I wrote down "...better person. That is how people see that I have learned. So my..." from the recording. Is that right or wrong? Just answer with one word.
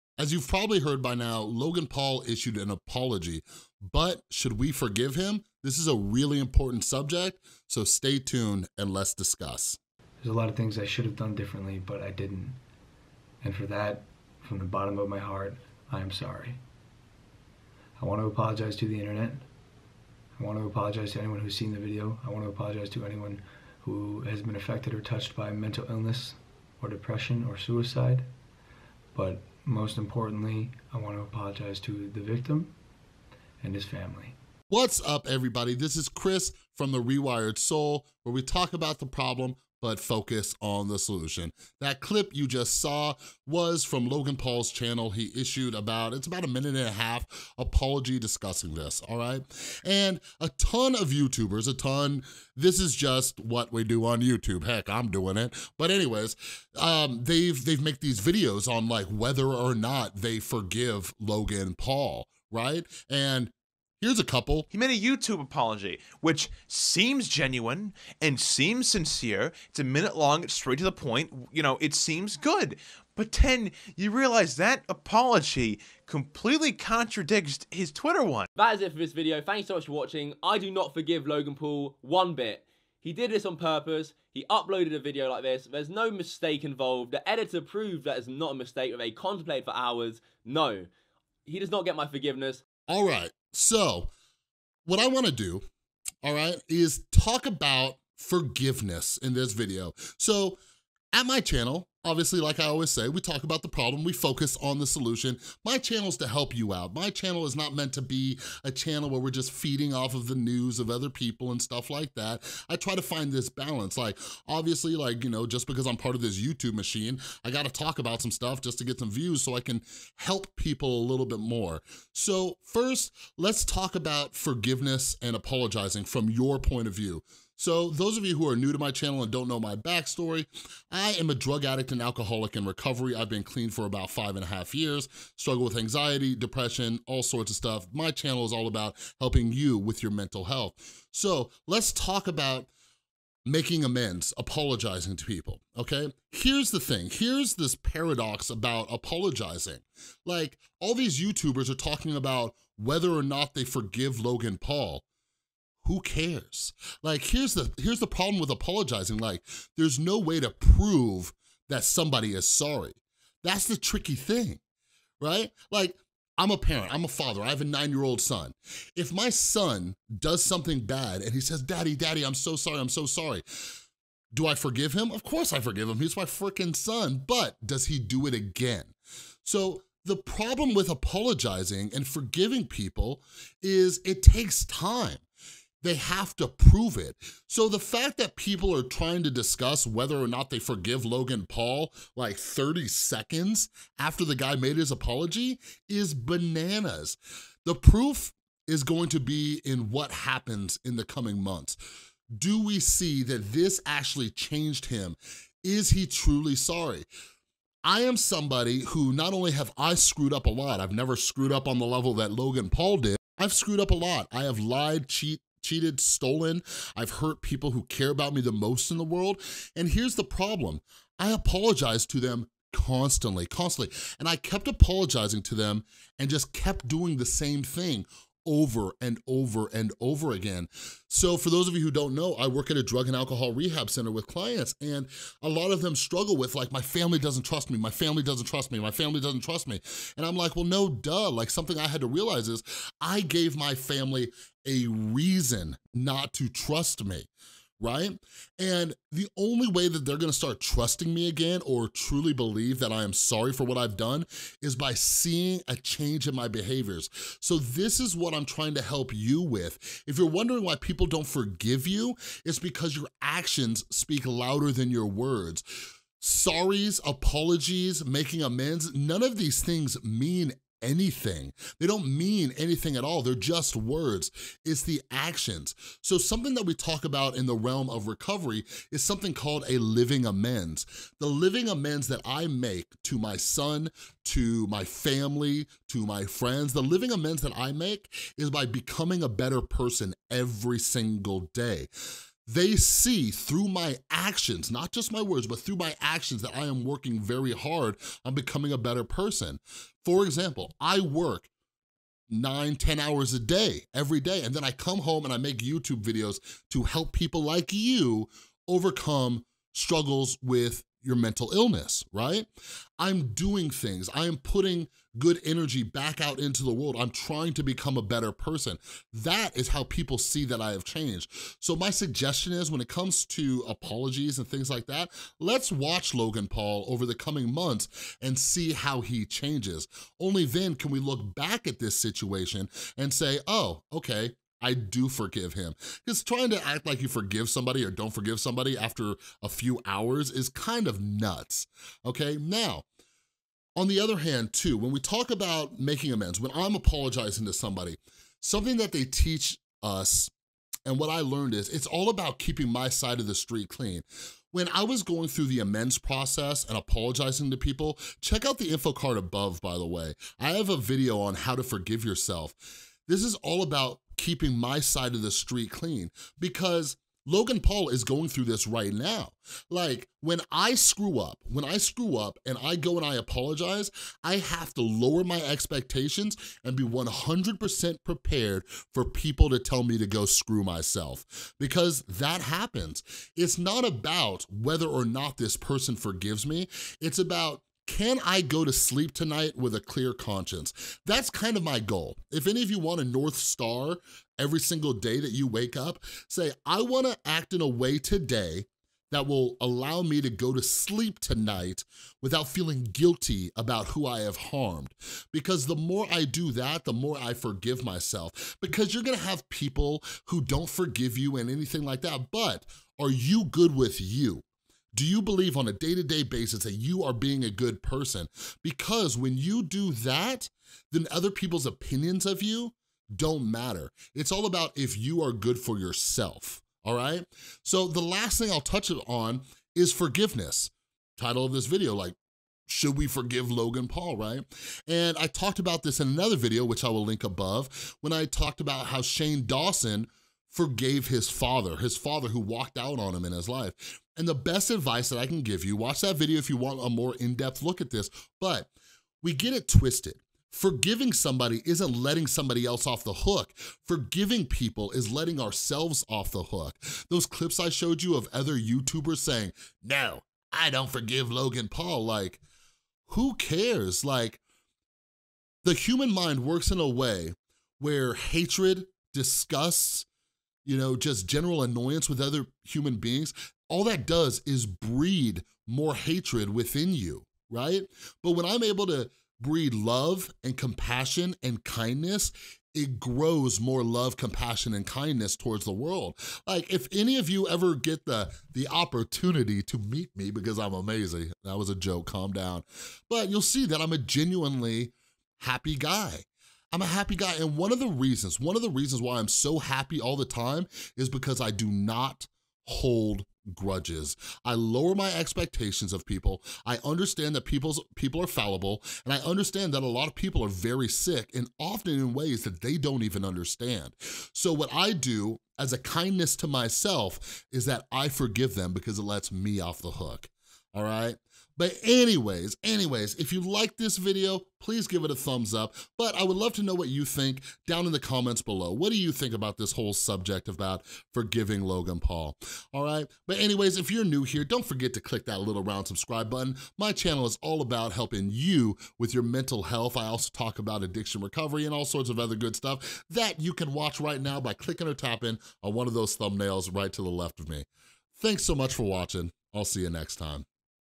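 wrong.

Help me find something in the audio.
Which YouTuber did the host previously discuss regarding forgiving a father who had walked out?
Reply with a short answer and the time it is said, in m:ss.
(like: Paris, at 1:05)
Shane Dawson, at 7:19.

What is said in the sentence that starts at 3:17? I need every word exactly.
The proof is going to be in what happens in the coming months.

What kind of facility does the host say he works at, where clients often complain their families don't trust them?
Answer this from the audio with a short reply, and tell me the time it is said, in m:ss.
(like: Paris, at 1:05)
drug and alcohol rehab center, at 3:52.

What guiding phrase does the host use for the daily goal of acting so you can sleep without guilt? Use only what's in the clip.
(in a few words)
North Star.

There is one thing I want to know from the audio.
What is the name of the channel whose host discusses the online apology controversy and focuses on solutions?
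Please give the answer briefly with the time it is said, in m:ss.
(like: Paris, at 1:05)
The Rewired Soul, at 0:36.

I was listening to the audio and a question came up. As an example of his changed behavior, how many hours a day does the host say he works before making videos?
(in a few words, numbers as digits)
9-10 hours.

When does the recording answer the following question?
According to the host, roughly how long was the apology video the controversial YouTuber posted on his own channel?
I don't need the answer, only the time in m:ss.
0:46.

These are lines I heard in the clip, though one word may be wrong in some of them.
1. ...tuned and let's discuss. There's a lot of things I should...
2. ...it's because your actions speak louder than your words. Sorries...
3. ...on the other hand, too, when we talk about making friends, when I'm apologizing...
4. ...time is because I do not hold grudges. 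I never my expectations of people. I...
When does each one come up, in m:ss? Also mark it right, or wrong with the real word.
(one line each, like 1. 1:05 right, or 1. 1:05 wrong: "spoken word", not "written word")
1. 0:08 right
2. 4:22 right
3. 5:43 wrong: "amends", not "friends"
4. 8:20 wrong: "lower", not "never".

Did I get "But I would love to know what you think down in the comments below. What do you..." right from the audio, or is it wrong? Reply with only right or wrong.
right.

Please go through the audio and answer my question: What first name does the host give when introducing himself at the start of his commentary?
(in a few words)
Chris.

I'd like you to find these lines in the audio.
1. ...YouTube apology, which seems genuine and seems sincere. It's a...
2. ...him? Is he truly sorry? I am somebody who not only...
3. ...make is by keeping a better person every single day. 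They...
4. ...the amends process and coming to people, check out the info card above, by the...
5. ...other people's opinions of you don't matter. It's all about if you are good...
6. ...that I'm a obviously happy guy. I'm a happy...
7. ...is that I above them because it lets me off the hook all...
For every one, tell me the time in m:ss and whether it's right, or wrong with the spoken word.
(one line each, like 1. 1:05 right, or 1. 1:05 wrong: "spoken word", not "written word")
1. 1:04 right
2. 3:24 right
3. 4:47 wrong: "becoming", not "keeping"
4. 5:55 wrong: "apologizing", not "coming"
5. 7:01 right
6. 8:13 wrong: "genuinely", not "obviously"
7. 8:37 wrong: "forgive", not "above".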